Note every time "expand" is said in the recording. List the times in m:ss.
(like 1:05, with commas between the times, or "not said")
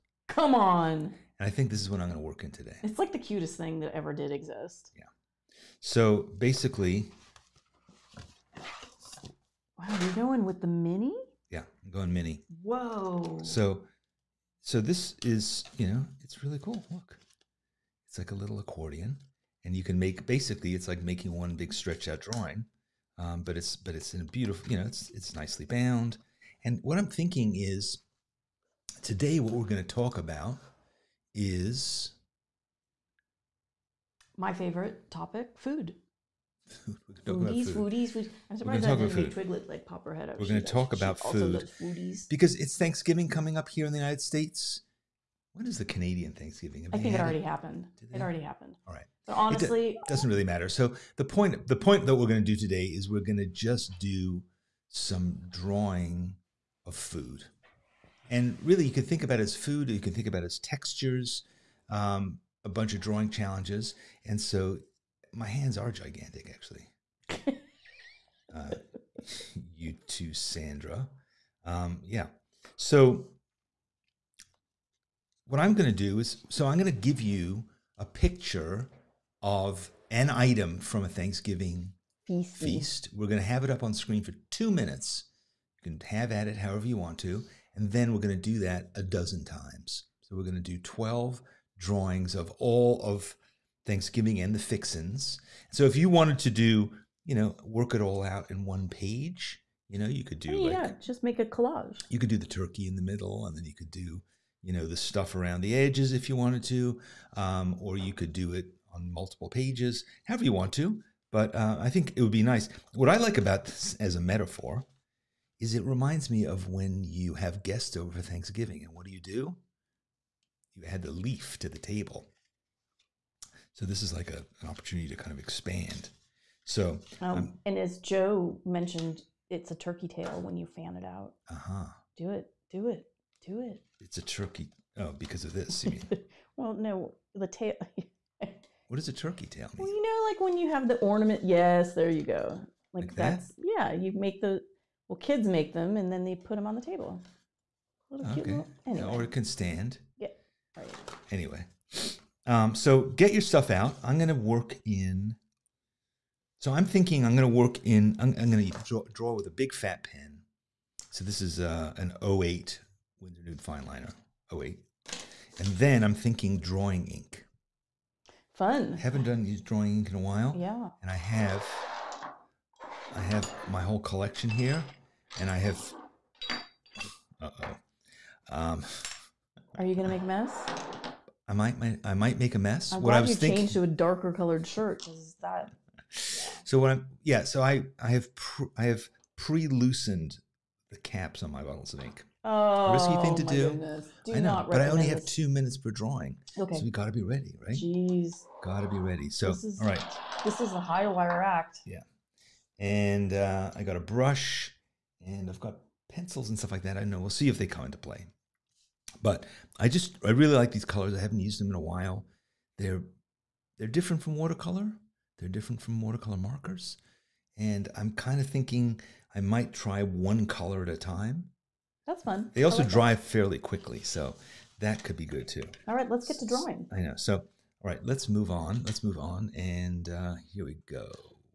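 2:05.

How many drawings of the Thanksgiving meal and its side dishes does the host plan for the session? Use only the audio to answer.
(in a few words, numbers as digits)
12.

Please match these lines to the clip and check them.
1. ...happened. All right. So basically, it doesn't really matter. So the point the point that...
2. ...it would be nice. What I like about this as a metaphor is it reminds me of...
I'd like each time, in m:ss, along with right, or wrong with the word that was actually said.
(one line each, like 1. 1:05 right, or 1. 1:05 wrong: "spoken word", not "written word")
1. 0:48 wrong: "honestly", not "basically"
2. 1:52 right.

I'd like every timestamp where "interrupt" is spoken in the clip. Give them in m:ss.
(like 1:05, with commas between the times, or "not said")
not said.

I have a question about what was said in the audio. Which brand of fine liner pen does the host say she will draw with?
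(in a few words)
Winsor Newton.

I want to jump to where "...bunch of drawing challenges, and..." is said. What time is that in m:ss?
1:02.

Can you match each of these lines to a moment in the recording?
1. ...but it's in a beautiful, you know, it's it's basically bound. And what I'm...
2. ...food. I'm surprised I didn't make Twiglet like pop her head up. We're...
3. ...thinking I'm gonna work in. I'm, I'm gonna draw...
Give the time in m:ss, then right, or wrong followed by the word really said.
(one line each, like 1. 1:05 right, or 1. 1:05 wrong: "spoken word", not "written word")
1. 0:23 wrong: "nicely", not "basically"
2. 0:38 right
3. 2:36 right.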